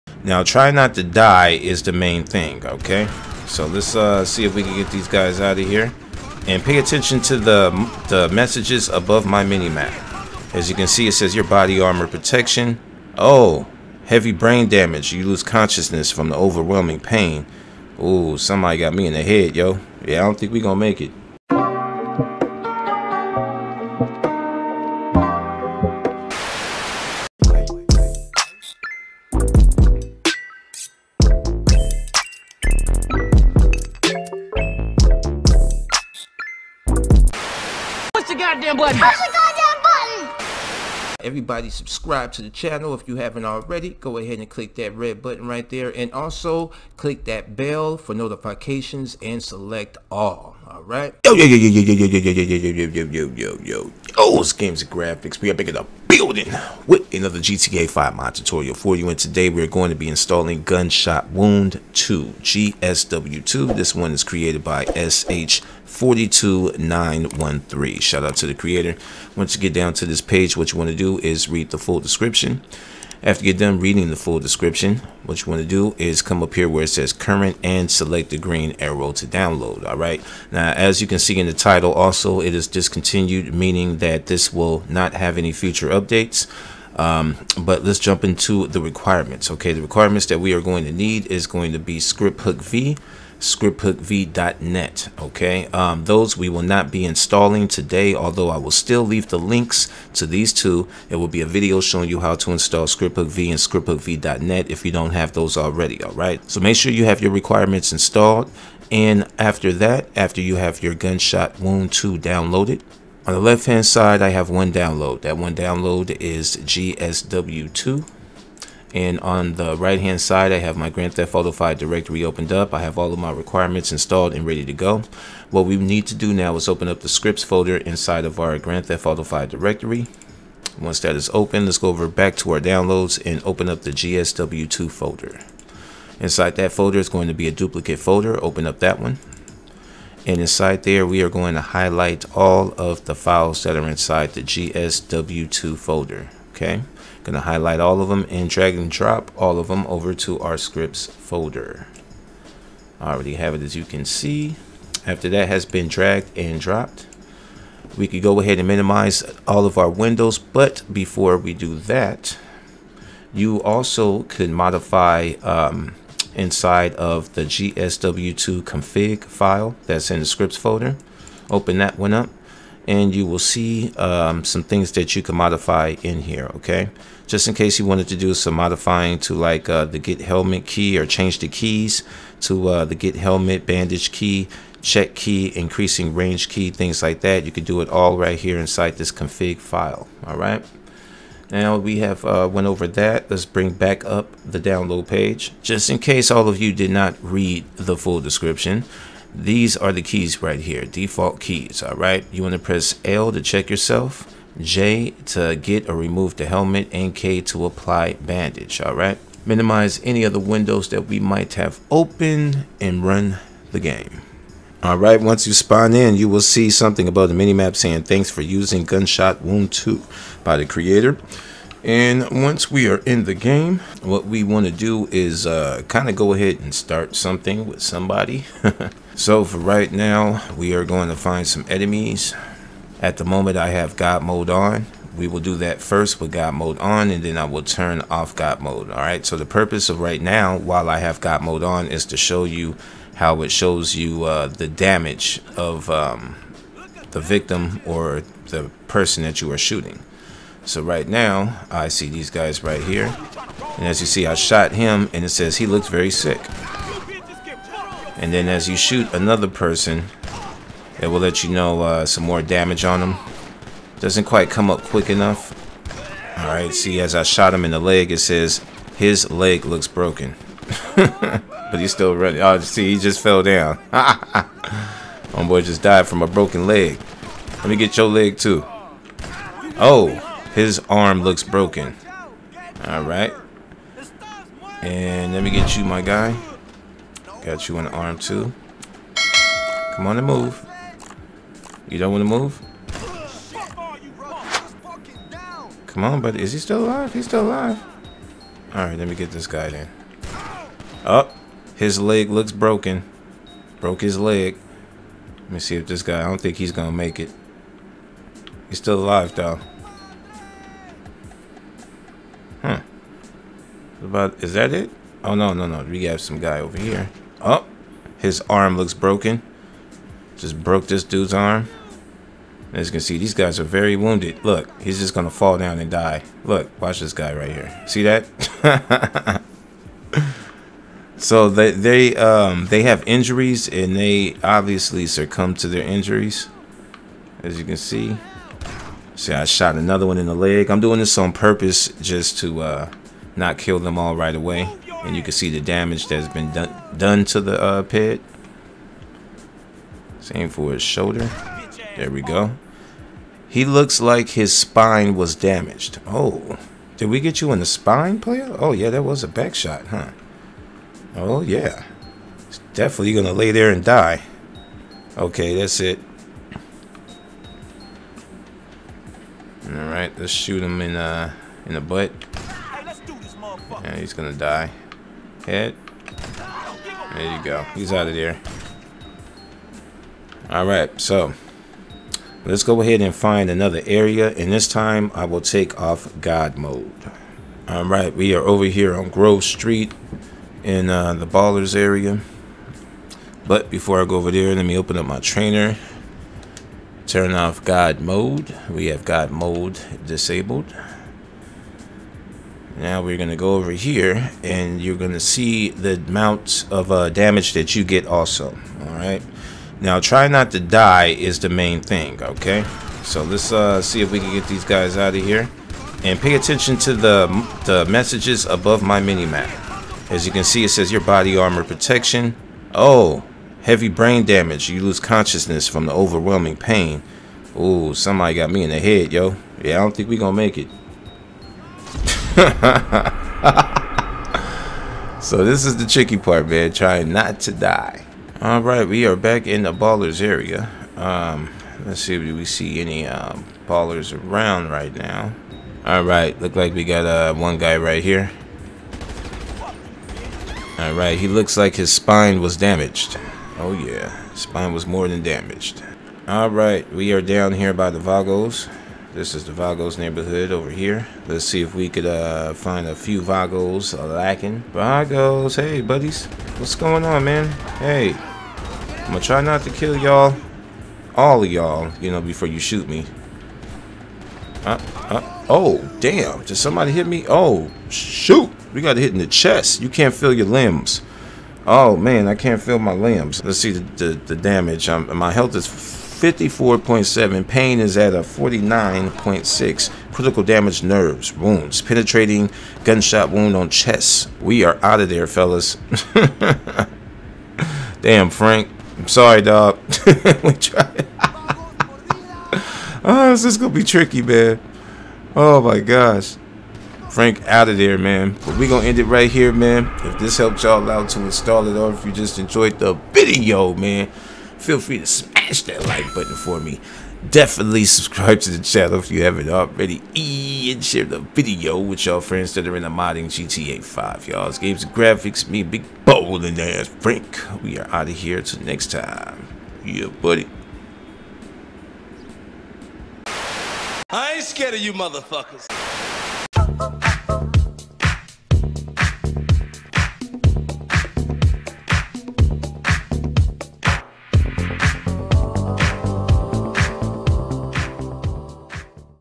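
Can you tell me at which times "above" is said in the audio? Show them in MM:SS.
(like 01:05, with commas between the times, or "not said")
00:08, 06:58.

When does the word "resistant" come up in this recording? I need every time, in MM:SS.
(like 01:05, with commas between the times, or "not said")
not said.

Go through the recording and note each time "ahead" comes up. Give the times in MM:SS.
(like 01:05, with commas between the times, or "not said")
02:38, 03:46, 06:22.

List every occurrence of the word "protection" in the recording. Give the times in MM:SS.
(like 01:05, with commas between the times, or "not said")
00:12, 07:01.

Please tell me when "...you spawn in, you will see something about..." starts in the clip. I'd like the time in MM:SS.
03:35.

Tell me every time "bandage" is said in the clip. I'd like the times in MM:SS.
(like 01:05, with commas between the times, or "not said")
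03:03, 03:28.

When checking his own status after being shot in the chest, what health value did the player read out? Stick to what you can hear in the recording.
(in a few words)
54.7.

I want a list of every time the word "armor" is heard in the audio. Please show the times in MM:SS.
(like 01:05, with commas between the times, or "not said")
00:11, 07:01.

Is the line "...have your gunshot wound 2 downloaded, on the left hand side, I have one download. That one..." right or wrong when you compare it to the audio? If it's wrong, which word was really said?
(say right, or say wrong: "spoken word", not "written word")
right.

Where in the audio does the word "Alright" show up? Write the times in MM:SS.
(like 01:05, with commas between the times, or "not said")
04:26, 04:42, 06:20, 06:27.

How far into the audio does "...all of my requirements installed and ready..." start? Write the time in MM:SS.
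02:02.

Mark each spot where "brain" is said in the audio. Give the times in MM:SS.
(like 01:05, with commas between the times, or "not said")
00:14, 07:03.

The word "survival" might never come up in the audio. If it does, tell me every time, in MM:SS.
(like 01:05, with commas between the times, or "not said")
not said.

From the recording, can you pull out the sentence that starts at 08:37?
Definitely subscribe to the channel if you haven't already.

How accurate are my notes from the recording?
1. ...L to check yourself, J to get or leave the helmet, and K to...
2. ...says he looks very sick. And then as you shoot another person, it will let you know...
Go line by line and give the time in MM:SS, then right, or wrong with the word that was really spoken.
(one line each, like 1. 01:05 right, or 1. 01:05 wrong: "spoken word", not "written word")
1. 03:23 wrong: "remove", not "leave"
2. 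04:15 right.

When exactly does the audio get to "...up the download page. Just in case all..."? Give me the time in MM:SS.
03:14.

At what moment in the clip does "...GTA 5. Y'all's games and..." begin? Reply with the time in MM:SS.
08:43.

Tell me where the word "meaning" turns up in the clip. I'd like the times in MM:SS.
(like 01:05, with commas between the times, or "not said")
01:23.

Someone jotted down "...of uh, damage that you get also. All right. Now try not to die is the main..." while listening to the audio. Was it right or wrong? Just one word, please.
right.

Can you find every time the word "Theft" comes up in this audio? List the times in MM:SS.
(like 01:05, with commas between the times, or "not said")
02:01, 02:08.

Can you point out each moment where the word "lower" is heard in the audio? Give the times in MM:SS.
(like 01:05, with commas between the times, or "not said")
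not said.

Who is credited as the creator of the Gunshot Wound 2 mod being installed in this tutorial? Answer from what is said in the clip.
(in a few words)
SH42913.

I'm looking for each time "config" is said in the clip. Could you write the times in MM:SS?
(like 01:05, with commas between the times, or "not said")
02:48, 03:09.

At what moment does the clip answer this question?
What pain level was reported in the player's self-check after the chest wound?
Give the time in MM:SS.
08:08.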